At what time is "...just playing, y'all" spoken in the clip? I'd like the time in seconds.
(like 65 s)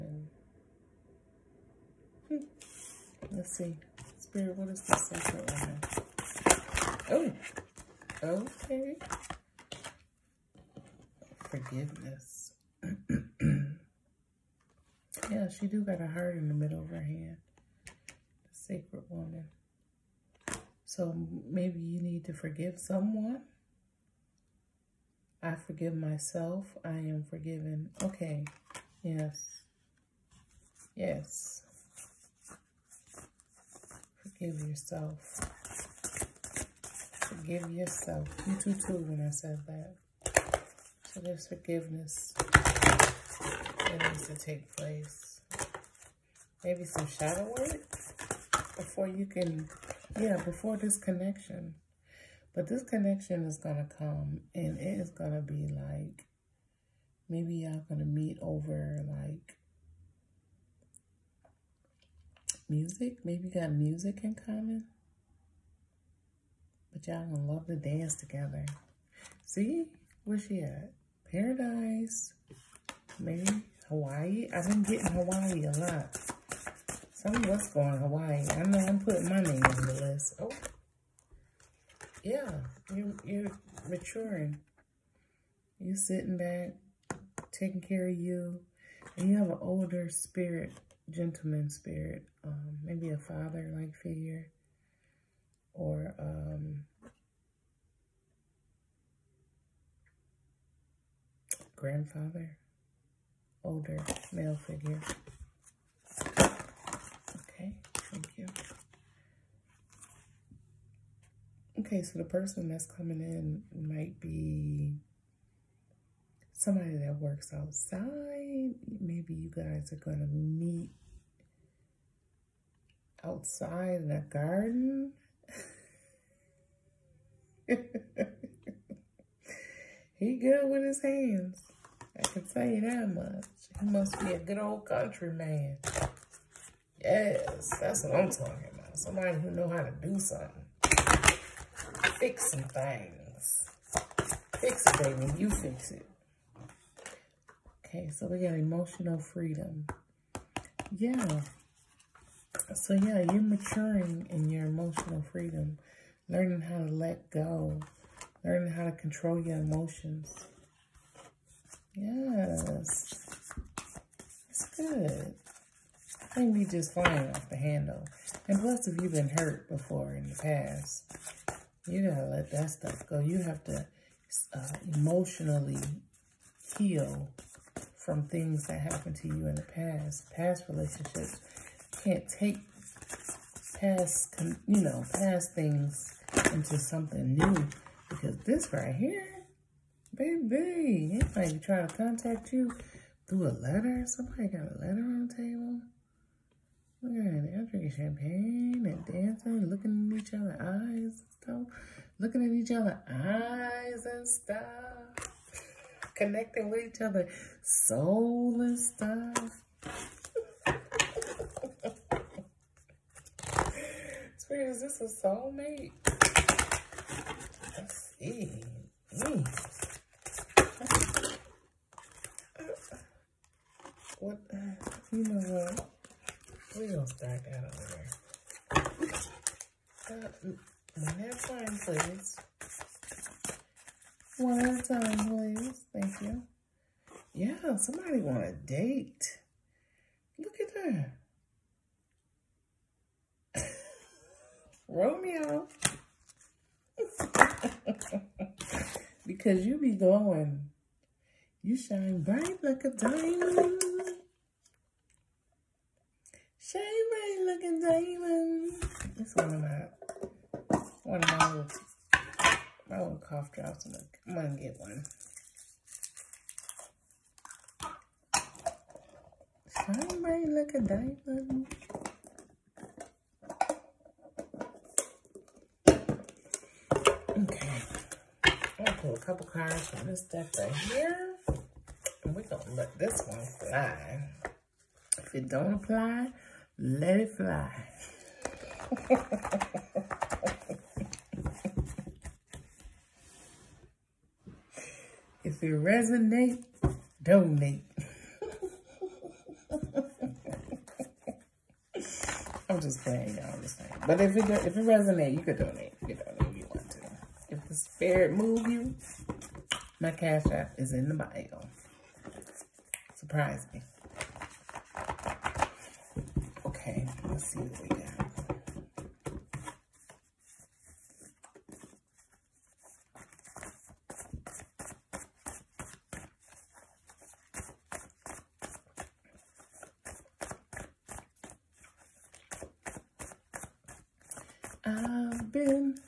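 302 s.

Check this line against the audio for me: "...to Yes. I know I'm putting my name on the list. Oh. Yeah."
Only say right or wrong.
wrong.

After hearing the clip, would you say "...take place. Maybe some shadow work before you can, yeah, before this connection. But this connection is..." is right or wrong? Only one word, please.
right.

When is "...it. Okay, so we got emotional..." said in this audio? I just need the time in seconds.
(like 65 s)
145 s.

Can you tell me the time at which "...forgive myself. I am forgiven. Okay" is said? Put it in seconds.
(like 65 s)
25 s.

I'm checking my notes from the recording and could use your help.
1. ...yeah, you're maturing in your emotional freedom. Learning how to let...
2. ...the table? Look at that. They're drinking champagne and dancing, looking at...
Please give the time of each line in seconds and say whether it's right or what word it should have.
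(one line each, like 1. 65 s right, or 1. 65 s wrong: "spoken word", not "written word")
1. 152 s right
2. 195 s right.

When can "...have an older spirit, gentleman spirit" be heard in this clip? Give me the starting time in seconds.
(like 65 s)
89 s.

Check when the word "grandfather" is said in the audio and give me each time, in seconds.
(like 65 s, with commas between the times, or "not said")
101 s.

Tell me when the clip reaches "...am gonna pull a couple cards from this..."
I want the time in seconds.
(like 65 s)
277 s.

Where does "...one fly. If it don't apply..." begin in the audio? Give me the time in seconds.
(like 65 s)
283 s.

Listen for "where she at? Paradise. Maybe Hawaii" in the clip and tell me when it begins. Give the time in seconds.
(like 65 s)
70 s.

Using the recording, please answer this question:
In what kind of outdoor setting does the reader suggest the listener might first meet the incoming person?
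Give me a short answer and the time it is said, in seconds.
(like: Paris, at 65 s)
A garden, at 124 s.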